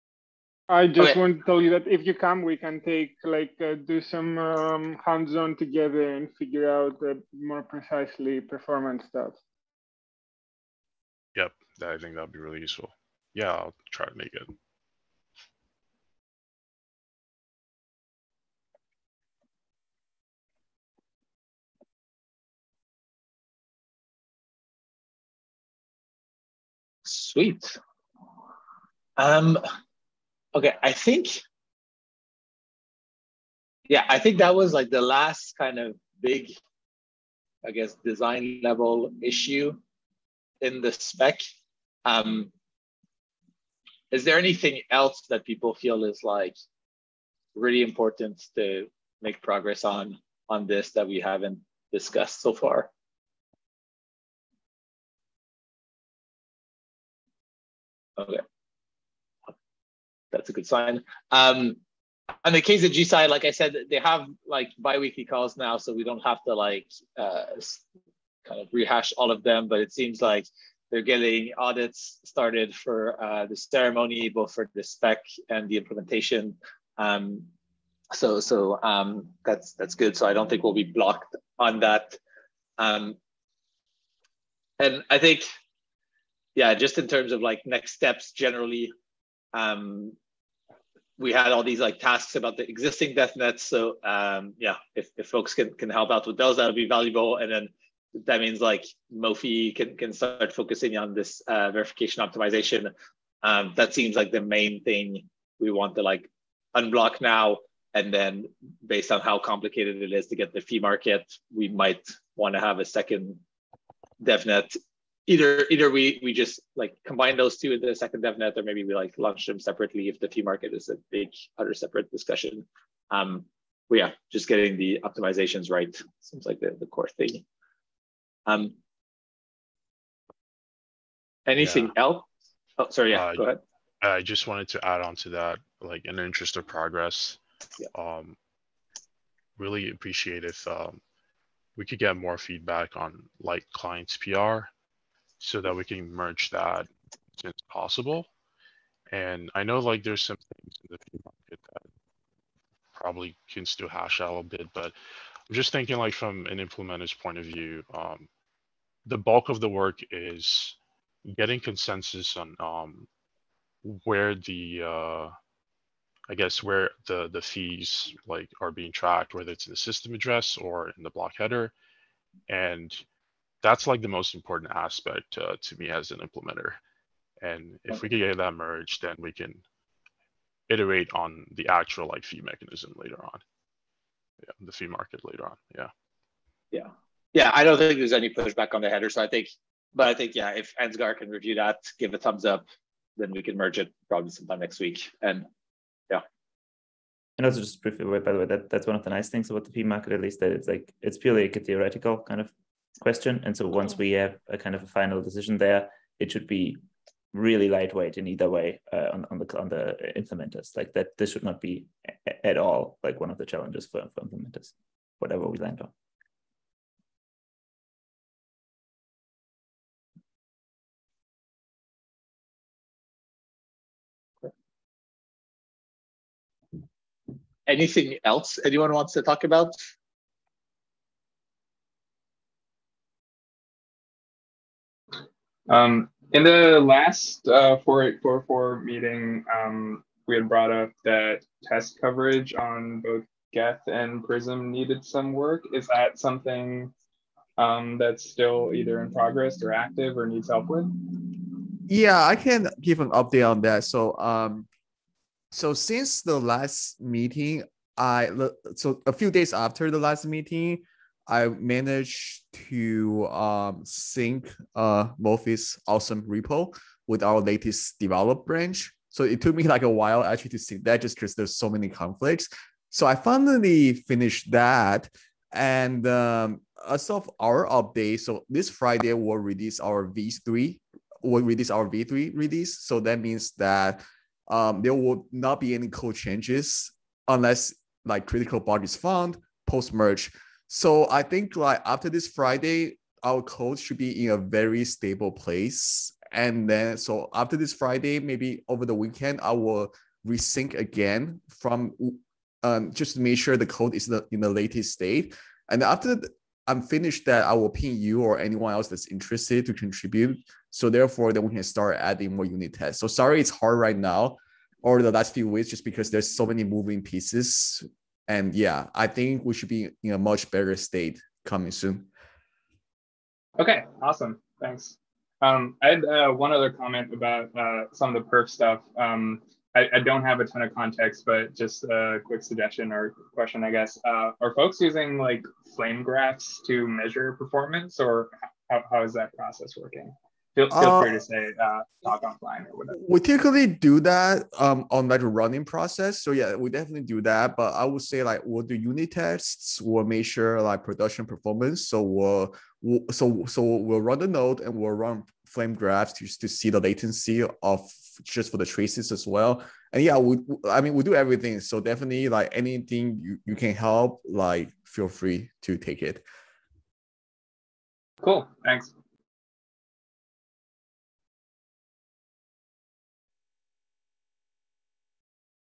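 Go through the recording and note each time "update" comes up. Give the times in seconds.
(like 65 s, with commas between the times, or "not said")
253 s, 277 s.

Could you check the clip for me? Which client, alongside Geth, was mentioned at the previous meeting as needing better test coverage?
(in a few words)
Prism.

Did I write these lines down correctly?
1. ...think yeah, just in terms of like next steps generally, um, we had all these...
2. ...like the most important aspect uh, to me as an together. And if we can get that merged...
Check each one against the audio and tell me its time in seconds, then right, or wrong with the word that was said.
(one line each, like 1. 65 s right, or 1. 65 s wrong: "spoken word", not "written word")
1. 85 s right
2. 173 s wrong: "implementer", not "together".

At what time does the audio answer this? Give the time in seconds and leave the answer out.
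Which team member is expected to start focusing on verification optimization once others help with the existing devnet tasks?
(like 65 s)
99 s.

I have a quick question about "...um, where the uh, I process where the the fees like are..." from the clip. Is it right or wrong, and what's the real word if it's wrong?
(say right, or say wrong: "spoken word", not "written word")
wrong: "guess", not "process".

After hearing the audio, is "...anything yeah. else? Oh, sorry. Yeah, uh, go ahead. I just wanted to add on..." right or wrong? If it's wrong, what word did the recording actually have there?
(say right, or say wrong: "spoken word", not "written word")
right.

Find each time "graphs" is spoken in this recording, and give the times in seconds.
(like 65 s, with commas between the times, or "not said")
336 s, 355 s.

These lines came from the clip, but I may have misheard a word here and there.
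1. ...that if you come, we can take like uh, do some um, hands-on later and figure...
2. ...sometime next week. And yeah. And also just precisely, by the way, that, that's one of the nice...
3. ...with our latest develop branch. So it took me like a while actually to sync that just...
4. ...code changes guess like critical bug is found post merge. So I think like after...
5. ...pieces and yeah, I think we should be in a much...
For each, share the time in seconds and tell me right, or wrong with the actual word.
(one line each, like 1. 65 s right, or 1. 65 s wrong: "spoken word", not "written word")
1. 1 s wrong: "together", not "later"
2. 194 s wrong: "briefly", not "precisely"
3. 267 s right
4. 285 s wrong: "unless", not "guess"
5. 317 s right.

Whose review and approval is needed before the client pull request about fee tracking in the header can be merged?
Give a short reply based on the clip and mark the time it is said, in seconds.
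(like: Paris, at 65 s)
Ansgar, at 190 s.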